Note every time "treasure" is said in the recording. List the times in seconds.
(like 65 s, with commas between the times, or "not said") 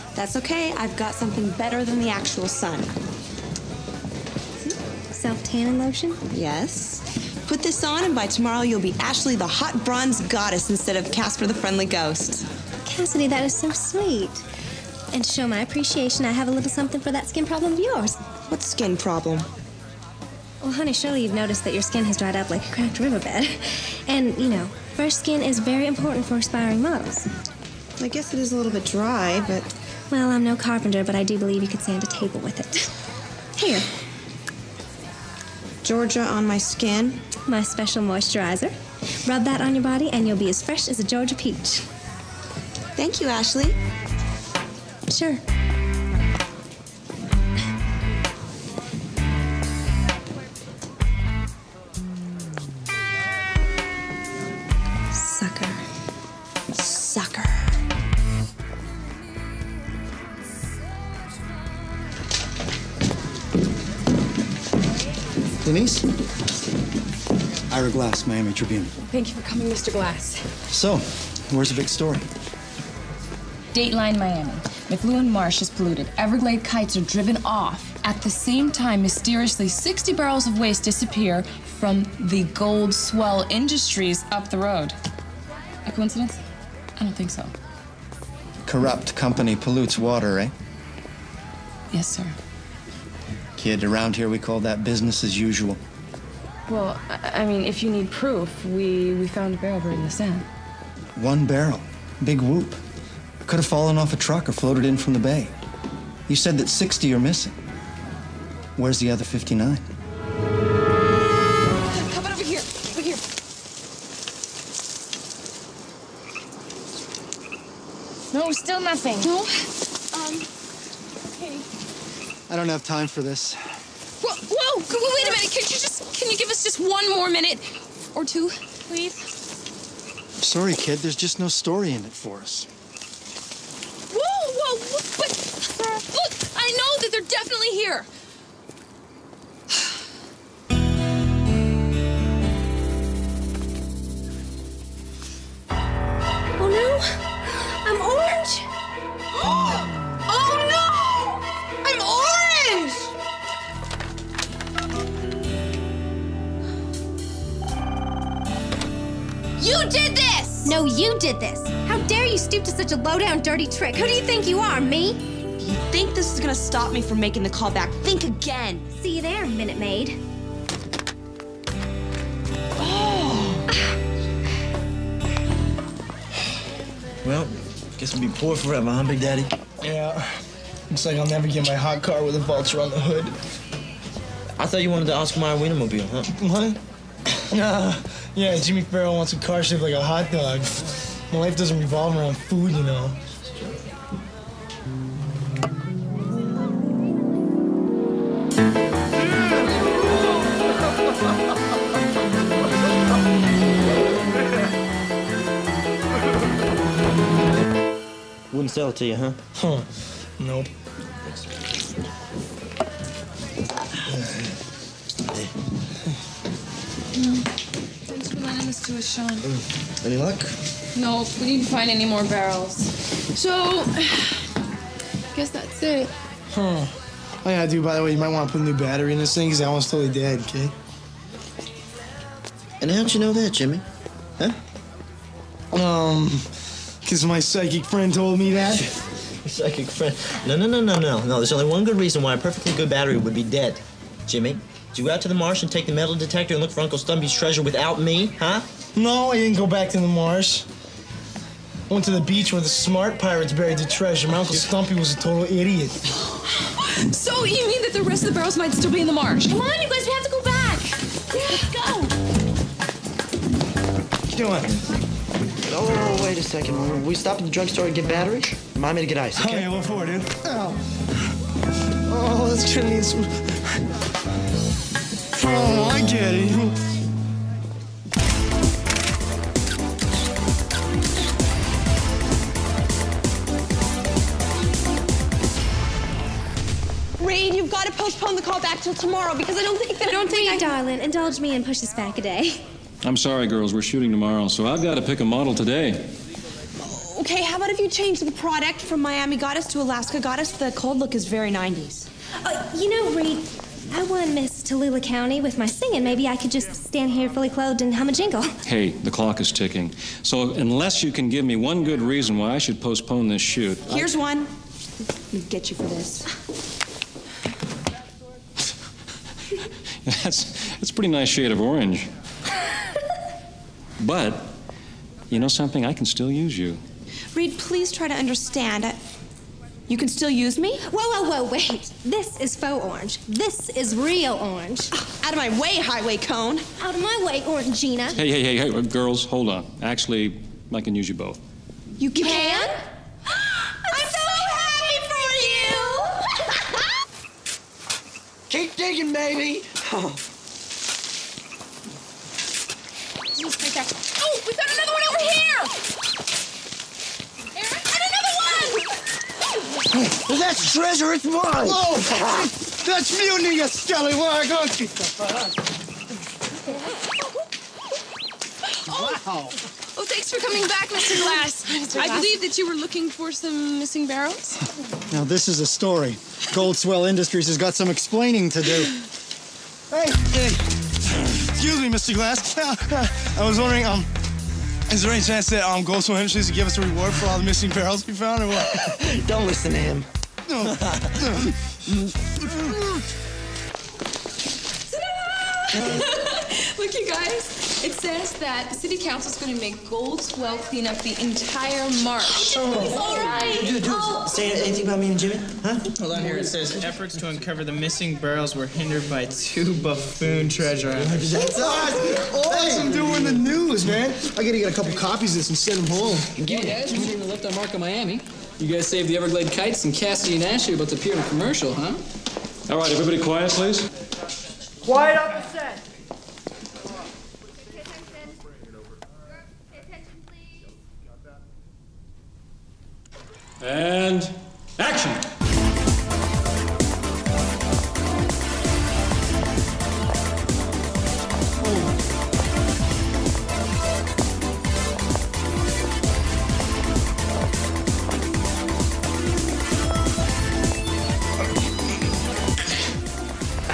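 247 s, 253 s, 360 s, 410 s.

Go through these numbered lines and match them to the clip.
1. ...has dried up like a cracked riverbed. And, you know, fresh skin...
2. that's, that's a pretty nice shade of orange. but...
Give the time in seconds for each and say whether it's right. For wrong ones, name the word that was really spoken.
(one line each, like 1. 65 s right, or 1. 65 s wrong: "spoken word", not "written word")
1. 22 s right
2. 320 s right.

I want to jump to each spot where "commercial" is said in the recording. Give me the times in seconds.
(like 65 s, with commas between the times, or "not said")
421 s.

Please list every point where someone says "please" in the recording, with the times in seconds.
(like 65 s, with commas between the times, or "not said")
128 s, 327 s, 423 s.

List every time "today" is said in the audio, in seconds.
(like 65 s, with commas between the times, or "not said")
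295 s.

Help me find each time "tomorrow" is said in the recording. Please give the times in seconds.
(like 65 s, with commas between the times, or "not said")
8 s, 288 s, 294 s.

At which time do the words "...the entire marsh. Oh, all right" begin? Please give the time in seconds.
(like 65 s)
400 s.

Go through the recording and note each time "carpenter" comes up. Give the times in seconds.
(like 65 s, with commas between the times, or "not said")
30 s.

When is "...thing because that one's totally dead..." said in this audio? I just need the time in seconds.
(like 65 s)
229 s.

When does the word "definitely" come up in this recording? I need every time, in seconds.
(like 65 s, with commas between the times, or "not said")
137 s.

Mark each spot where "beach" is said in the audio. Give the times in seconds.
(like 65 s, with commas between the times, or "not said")
252 s.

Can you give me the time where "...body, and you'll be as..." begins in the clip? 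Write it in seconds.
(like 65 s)
39 s.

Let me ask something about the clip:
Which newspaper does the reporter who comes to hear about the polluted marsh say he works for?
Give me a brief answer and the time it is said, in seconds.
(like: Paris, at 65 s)
Miami Tribune, at 68 s.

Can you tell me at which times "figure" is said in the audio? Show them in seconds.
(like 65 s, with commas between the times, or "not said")
not said.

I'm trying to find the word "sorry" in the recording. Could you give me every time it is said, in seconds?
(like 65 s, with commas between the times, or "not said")
130 s, 293 s.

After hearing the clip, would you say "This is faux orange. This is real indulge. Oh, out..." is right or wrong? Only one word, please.
wrong.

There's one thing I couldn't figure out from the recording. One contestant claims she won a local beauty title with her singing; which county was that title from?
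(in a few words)
Tallulah County.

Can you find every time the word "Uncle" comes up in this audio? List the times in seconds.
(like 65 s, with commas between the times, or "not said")
246 s, 254 s.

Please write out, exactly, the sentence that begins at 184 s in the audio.
I thought you wanted the Oscar Mayer Wienermobile, huh?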